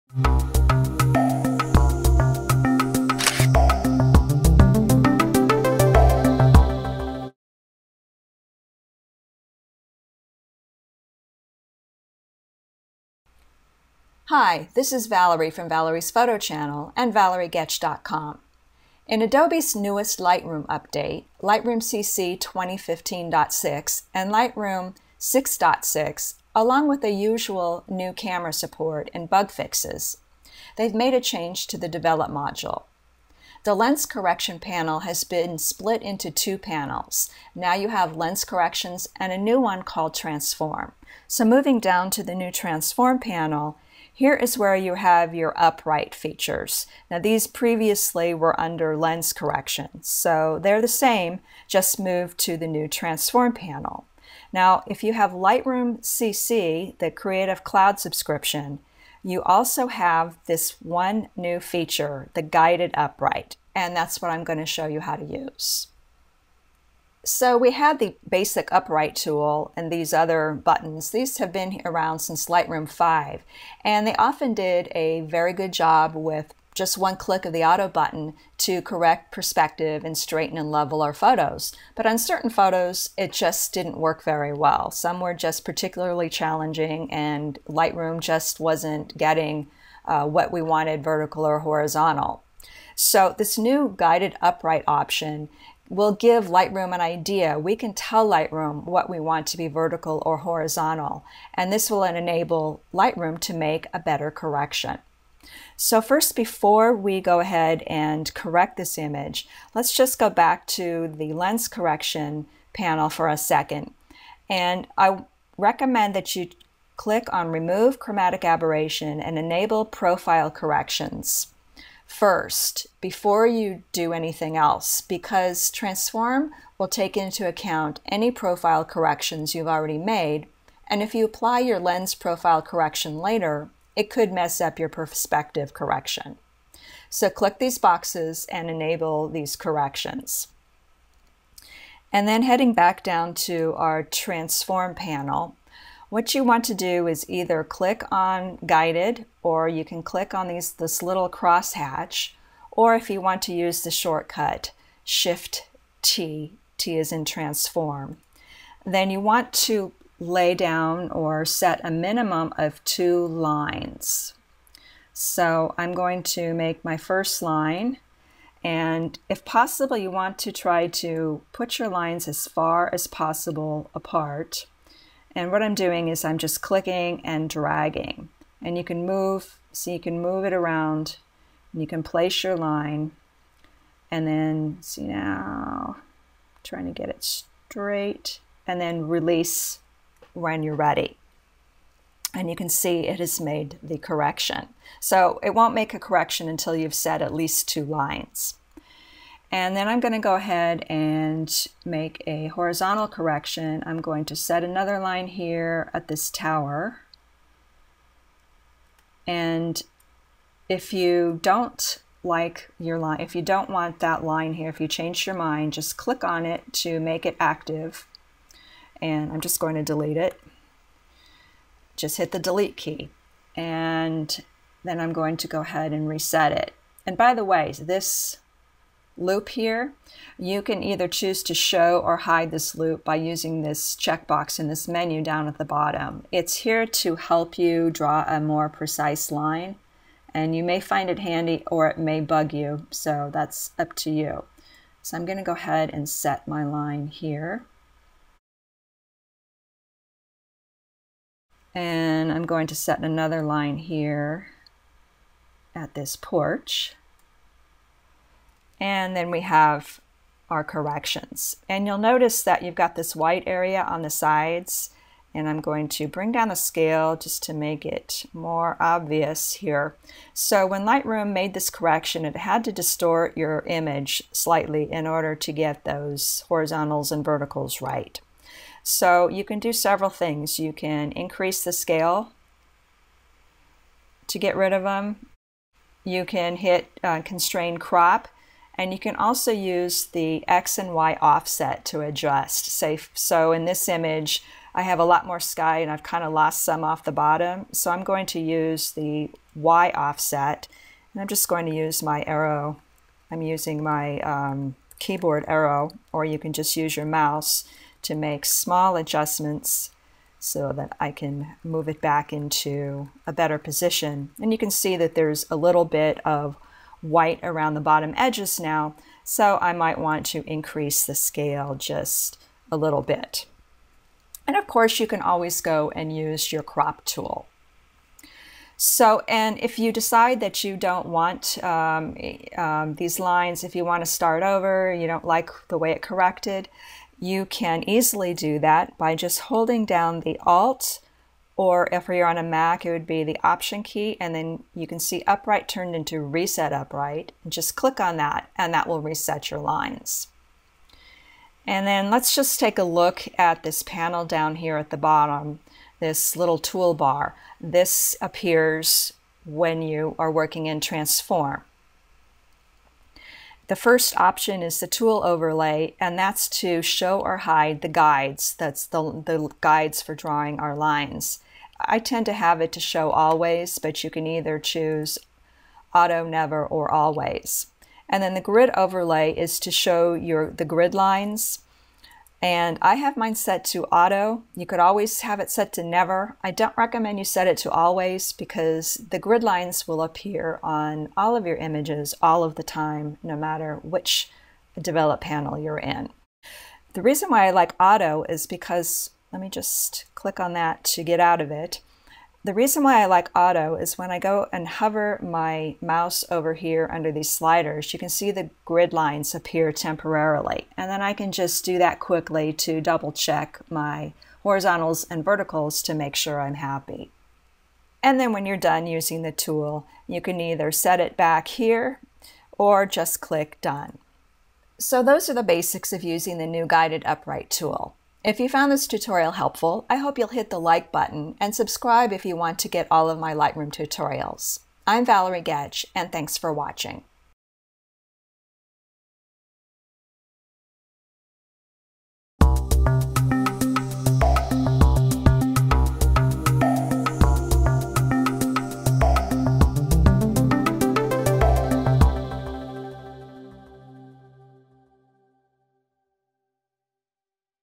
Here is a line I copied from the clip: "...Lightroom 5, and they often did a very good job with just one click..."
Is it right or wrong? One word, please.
right.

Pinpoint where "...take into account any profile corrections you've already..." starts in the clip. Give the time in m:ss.
2:06.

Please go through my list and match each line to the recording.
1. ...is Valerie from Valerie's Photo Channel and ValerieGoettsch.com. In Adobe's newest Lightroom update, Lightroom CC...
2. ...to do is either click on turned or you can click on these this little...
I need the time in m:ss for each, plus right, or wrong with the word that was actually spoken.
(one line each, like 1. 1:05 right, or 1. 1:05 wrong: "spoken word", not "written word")
1. 0:14 right
2. 2:26 wrong: "guided", not "turned".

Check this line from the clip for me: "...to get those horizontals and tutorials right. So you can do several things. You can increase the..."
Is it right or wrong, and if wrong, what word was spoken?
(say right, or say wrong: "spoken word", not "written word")
wrong: "verticals", not "tutorials".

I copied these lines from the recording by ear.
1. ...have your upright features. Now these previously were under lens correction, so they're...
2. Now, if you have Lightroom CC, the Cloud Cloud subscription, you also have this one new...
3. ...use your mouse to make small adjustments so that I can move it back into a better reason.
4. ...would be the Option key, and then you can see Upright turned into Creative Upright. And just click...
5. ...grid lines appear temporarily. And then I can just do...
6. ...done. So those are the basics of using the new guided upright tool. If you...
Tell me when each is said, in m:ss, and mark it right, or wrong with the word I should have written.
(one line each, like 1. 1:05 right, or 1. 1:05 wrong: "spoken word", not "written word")
1. 0:44 right
2. 0:54 wrong: "Creative", not "Cloud"
3. 5:06 wrong: "position", not "reason"
4. 5:42 wrong: "Reset", not "Creative"
5. 6:48 right
6. 7:03 right.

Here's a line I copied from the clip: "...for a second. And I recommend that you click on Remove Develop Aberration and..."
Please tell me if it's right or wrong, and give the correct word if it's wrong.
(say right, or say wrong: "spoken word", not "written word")
wrong: "Chromatic", not "Develop".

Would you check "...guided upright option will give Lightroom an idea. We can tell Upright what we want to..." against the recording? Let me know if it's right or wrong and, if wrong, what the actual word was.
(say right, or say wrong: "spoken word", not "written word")
wrong: "Lightroom", not "Upright".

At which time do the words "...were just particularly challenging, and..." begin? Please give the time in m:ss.
1:25.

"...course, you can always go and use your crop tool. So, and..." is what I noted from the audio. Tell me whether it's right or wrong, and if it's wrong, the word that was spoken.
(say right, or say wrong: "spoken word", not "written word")
right.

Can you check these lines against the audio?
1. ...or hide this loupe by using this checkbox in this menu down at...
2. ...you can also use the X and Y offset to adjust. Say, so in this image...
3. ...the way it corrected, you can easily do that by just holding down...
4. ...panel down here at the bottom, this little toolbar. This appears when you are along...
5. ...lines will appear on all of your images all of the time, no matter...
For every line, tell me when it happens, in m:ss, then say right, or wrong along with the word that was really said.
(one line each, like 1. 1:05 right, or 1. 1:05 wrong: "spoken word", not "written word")
1. 3:51 right
2. 4:48 right
3. 5:35 right
4. 5:53 wrong: "working", not "along"
5. 6:29 right.